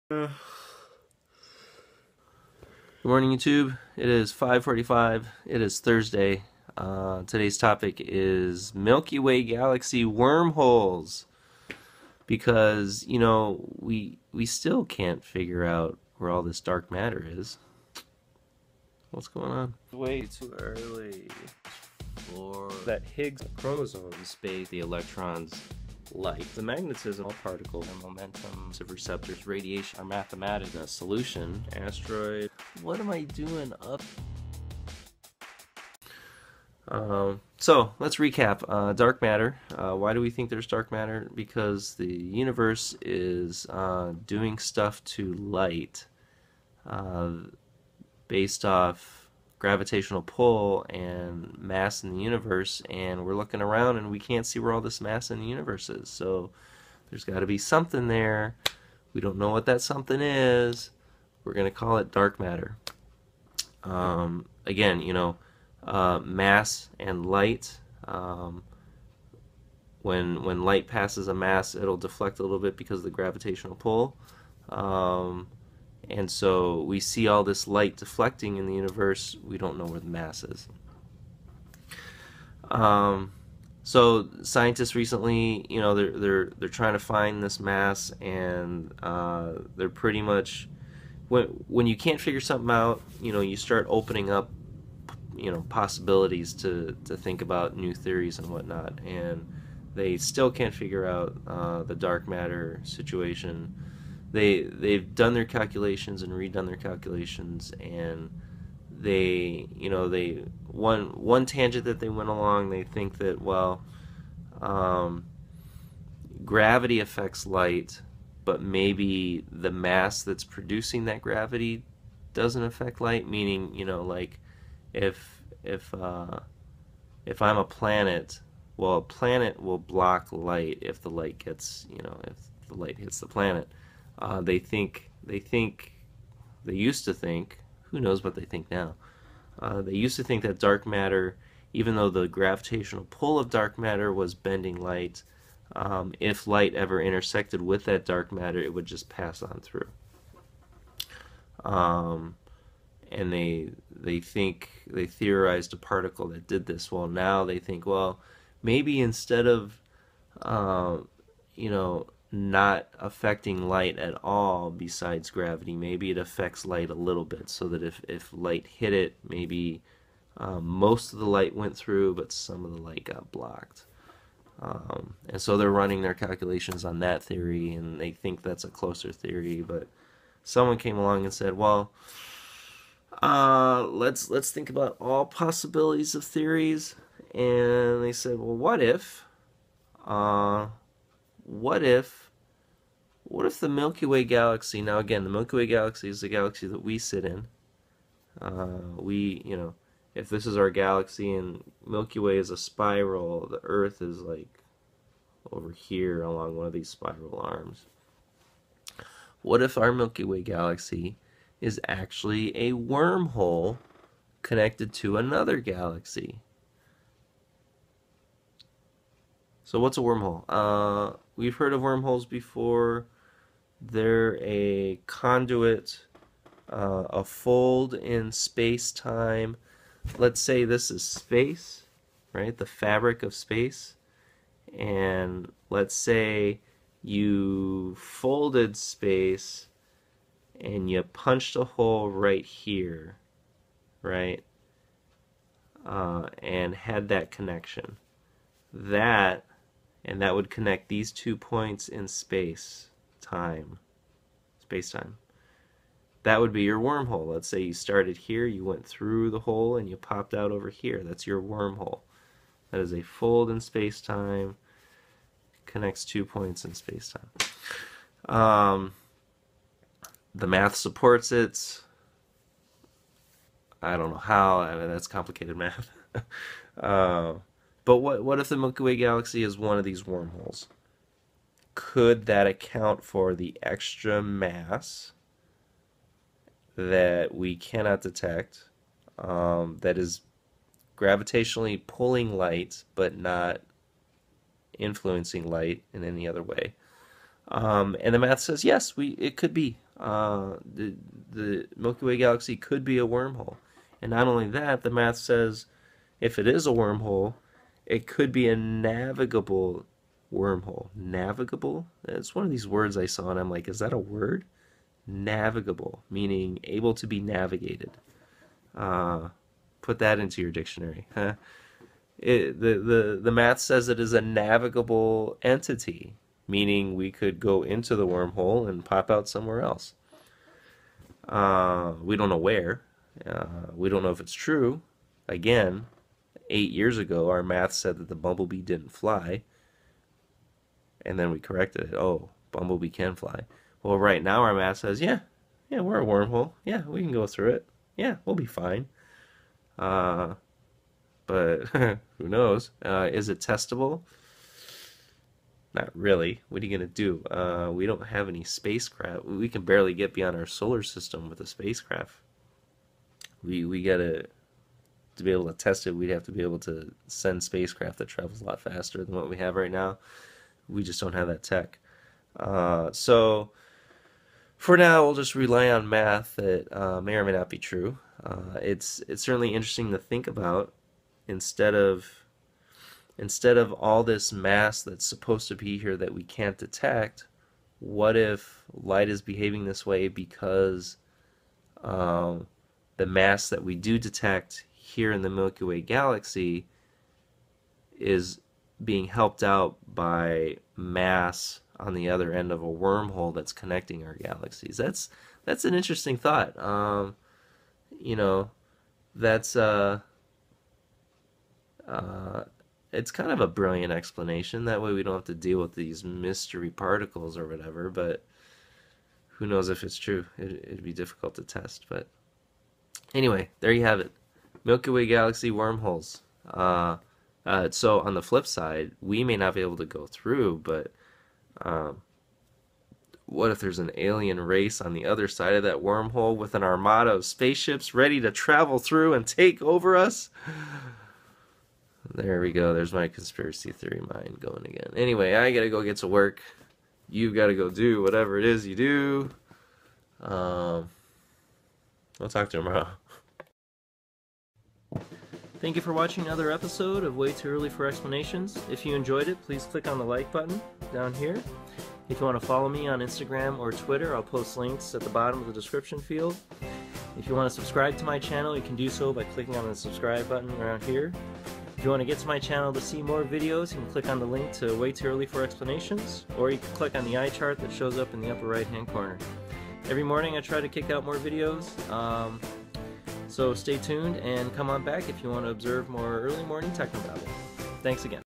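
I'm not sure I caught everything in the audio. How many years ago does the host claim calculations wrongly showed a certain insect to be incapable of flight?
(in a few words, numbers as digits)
8.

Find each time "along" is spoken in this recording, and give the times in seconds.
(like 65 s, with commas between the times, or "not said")
112 s, 180 s, 206 s.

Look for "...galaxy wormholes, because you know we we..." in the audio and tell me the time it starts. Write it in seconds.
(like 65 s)
9 s.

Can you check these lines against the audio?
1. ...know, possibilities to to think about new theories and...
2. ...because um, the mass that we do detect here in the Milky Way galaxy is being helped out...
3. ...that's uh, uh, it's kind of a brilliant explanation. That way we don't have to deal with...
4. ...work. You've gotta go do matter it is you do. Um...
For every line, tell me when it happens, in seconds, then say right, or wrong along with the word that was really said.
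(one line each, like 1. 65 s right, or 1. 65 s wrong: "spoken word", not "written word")
1. 95 s right
2. 390 s right
3. 409 s right
4. 446 s wrong: "whatever", not "matter".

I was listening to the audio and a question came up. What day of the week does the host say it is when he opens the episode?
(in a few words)
Thursday.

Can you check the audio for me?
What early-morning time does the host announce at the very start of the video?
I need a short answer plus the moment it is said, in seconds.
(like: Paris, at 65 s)
5:45, at 3 s.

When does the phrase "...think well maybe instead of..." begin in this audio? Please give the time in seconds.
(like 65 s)
157 s.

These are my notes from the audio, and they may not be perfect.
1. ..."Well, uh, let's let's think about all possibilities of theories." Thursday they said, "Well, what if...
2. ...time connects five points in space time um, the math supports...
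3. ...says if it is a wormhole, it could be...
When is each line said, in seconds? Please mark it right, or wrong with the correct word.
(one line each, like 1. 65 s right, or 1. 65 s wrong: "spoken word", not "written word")
1. 181 s wrong: "And", not "Thursday"
2. 264 s wrong: "two", not "five"
3. 305 s right.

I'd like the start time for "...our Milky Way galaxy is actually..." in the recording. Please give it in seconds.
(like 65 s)
209 s.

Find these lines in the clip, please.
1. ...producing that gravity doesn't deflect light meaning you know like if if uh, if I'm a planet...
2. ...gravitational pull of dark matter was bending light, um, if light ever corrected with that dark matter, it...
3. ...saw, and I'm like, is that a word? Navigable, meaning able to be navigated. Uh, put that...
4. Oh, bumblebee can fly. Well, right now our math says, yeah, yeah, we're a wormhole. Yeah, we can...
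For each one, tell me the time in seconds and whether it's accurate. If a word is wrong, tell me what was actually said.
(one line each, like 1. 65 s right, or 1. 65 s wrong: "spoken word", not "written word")
1. 120 s wrong: "affect", not "deflect"
2. 142 s wrong: "intersected", not "corrected"
3. 313 s right
4. 341 s right.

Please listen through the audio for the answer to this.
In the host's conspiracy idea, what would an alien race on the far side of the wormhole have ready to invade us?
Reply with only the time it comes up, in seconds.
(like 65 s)
436 s.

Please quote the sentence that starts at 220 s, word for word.
Uh, we've heard of wormholes before.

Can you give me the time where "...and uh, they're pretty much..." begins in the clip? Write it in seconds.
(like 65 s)
88 s.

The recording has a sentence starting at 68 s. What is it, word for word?
Um, when when light passes a mass, it'll deflect a little bit because of the gravitational pull.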